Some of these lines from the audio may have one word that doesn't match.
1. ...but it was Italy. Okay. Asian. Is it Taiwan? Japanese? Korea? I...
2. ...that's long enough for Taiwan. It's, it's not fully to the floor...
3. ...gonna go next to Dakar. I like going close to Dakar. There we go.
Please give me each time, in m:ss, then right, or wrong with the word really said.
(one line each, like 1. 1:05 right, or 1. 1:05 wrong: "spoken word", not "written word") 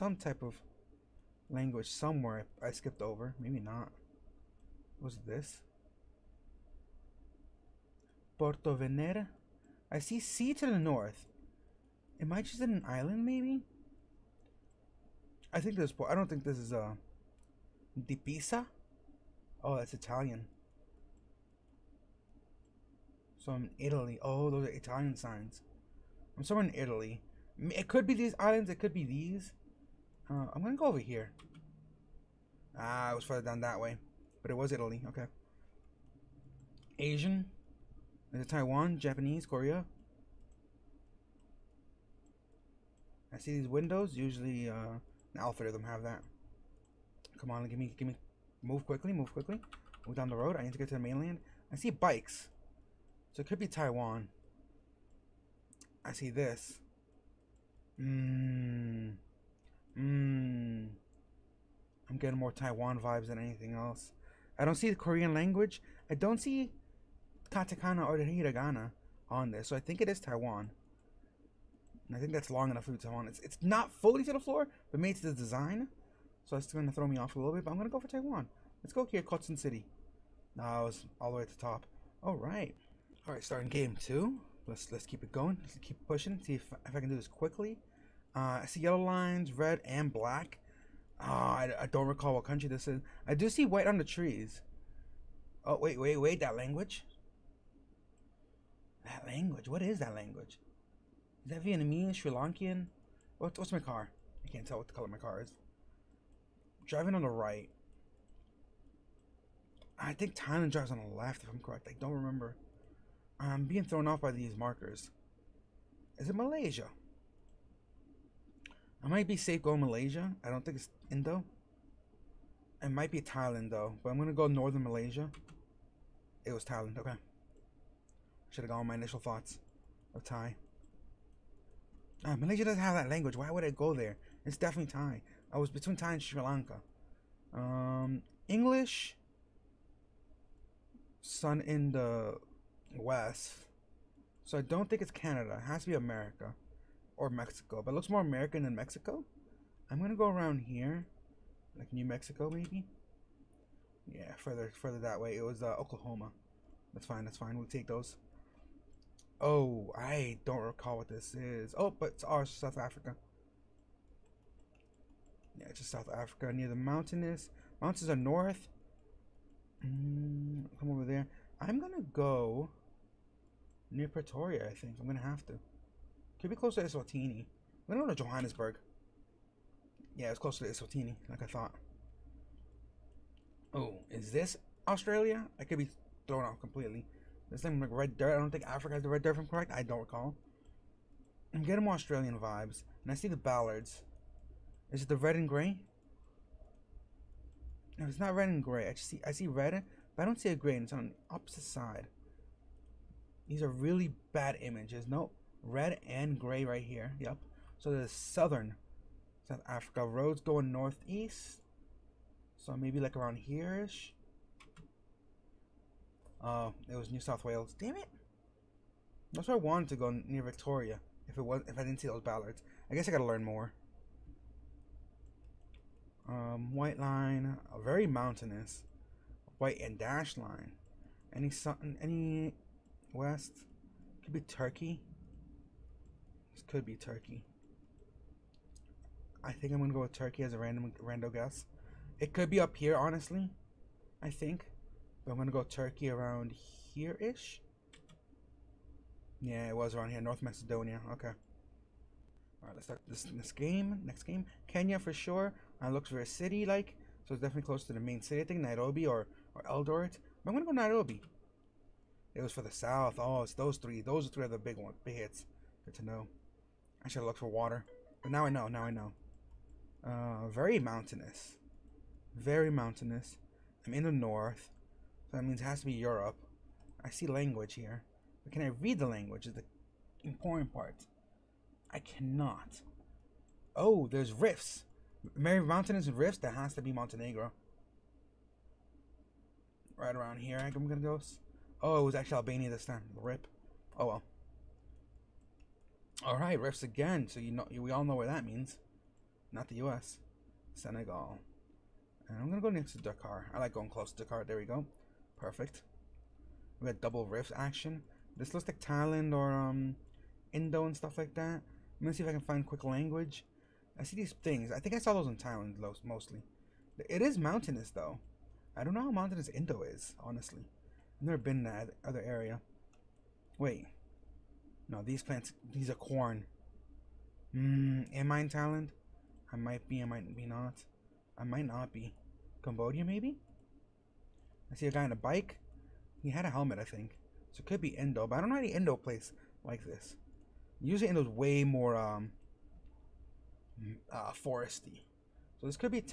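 1. 0:34 right
2. 1:12 right
3. 5:02 right.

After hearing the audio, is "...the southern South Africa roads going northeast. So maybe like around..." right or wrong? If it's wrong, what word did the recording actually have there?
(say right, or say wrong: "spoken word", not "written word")
right.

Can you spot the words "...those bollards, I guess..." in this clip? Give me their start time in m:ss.
3:42.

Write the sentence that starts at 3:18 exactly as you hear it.
I see I see red but I don't see a grain.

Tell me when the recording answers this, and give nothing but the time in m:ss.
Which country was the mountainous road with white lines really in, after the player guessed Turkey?
4:10.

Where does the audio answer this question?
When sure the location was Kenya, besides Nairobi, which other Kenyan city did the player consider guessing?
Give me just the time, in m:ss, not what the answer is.
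4:19.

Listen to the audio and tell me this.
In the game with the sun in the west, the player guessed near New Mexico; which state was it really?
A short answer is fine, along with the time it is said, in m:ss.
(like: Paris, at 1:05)
Oklahoma, at 2:35.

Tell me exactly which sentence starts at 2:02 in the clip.
It might be Thailand though, but I'm gonna go northern Malaysia.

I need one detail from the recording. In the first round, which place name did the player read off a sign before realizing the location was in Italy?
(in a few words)
Porto Venera.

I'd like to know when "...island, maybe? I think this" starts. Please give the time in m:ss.
0:12.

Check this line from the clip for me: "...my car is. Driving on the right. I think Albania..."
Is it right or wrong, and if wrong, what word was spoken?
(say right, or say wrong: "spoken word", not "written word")
wrong: "Thailand", not "Albania".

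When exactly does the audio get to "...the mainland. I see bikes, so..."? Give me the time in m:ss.
0:50.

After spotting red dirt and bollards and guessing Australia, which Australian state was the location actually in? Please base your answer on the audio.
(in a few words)
New South Wales.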